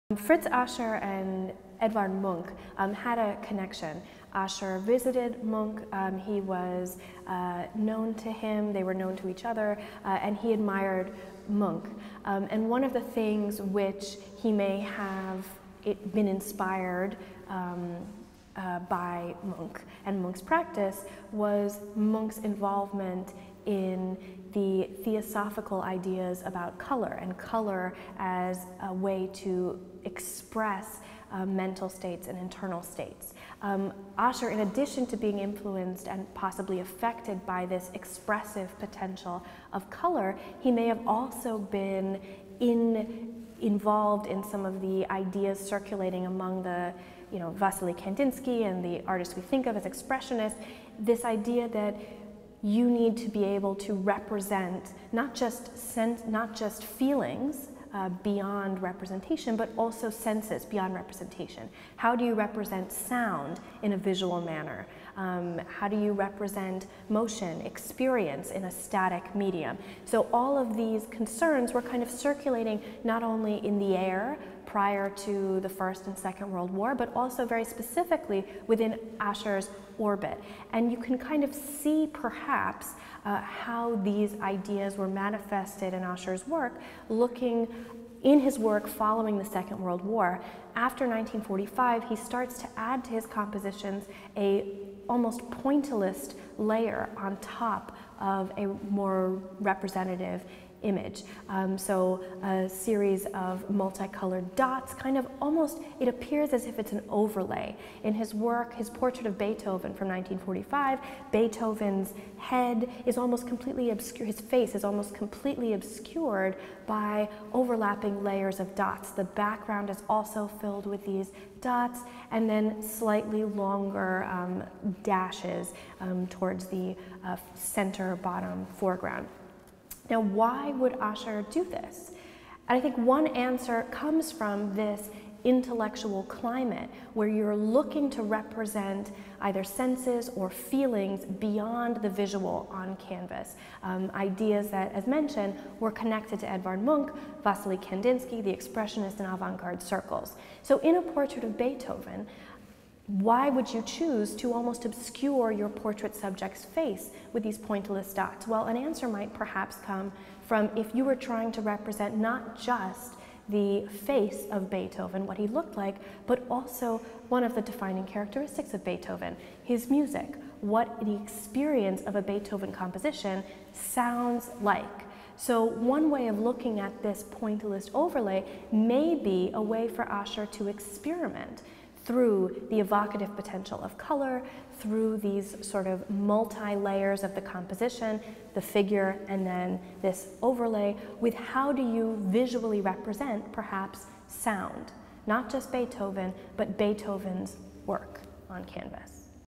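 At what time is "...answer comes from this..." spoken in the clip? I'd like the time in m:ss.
2:13.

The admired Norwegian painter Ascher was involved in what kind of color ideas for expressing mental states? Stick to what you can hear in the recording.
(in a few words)
Theosophical.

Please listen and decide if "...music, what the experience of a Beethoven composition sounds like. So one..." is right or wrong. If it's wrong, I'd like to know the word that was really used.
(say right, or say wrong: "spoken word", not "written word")
right.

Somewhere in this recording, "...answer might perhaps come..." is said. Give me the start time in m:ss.
2:38.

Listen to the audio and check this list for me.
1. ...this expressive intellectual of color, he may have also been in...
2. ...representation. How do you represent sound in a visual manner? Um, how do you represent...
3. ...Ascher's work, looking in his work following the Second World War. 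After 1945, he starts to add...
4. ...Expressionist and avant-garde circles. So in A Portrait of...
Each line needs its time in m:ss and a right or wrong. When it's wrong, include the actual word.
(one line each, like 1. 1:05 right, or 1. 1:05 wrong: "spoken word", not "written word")
1. 0:37 wrong: "potential", not "intellectual"
2. 1:00 right
3. 1:26 right
4. 2:28 right.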